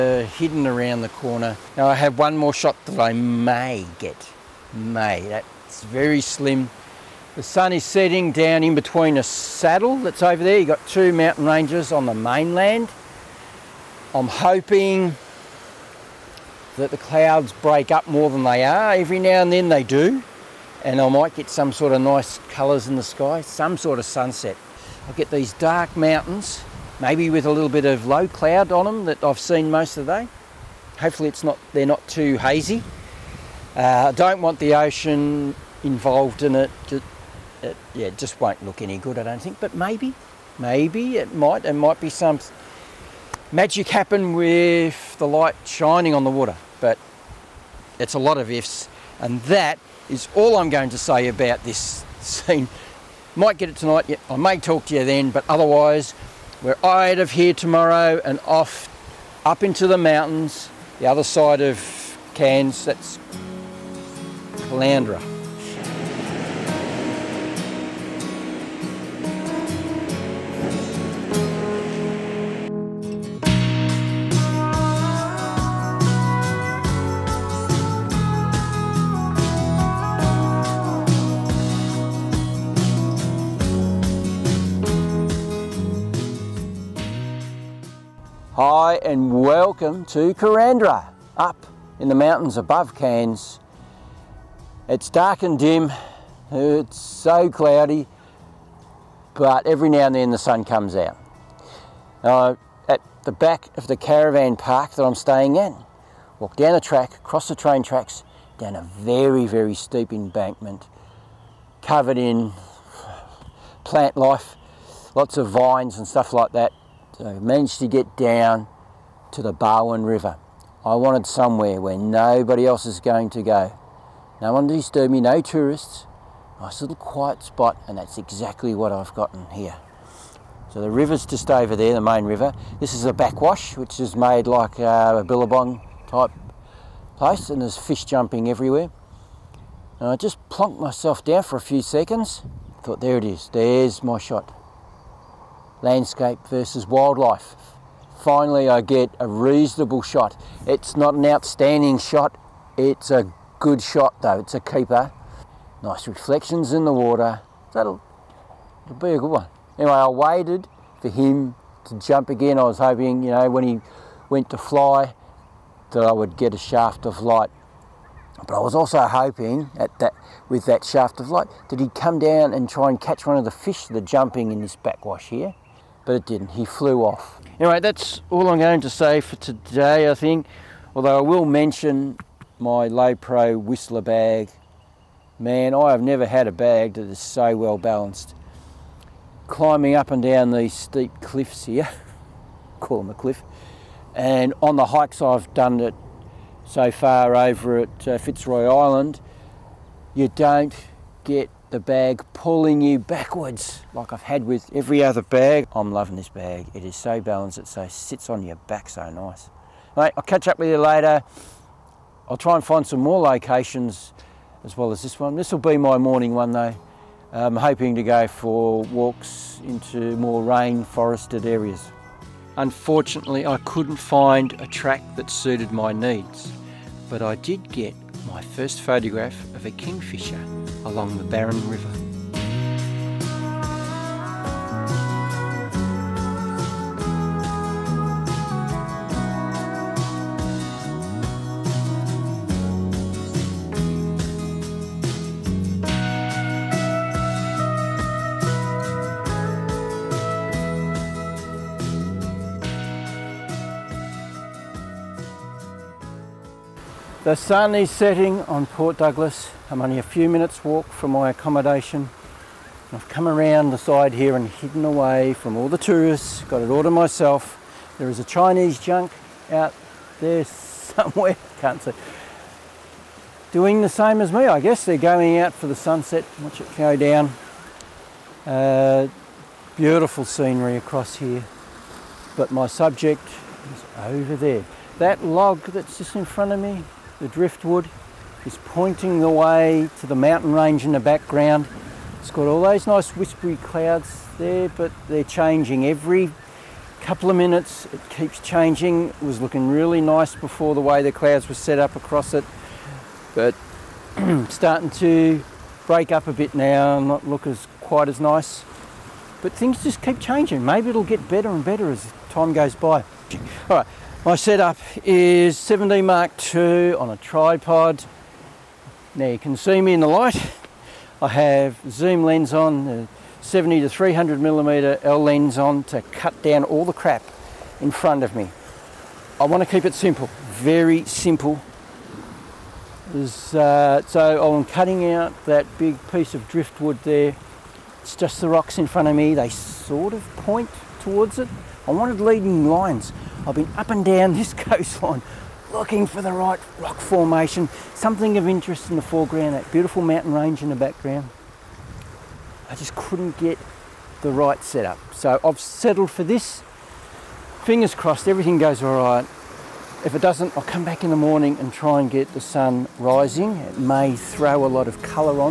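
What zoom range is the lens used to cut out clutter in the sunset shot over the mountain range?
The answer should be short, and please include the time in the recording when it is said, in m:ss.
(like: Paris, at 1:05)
70 to 300 millimeter, at 5:23.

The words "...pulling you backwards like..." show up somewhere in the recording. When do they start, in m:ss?
3:22.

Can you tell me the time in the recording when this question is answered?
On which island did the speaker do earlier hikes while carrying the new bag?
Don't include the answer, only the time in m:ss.
3:18.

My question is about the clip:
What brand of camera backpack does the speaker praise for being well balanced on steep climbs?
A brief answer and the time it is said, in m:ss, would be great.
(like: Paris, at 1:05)
Lowepro, at 3:02.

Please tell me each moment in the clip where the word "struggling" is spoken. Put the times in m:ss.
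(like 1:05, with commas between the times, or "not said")
not said.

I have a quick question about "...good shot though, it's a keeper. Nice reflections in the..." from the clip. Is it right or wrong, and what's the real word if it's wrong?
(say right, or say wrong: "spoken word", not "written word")
right.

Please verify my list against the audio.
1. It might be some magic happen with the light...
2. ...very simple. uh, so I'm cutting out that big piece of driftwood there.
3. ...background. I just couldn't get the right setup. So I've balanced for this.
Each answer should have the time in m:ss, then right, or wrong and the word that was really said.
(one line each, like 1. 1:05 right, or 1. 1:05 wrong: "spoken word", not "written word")
1. 0:41 right
2. 5:30 right
3. 5:50 wrong: "settled", not "balanced".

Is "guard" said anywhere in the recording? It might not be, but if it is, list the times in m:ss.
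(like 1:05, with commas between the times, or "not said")
not said.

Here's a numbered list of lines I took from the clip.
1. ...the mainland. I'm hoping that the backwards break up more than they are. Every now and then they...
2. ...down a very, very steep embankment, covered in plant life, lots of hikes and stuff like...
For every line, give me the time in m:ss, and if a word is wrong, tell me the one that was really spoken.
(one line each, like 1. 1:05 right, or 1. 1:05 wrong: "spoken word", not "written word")
1. 0:12 wrong: "clouds", not "backwards"
2. 1:48 wrong: "vines", not "hikes".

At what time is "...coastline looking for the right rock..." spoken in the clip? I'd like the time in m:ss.
5:44.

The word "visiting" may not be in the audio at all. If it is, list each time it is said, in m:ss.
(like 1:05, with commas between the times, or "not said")
not said.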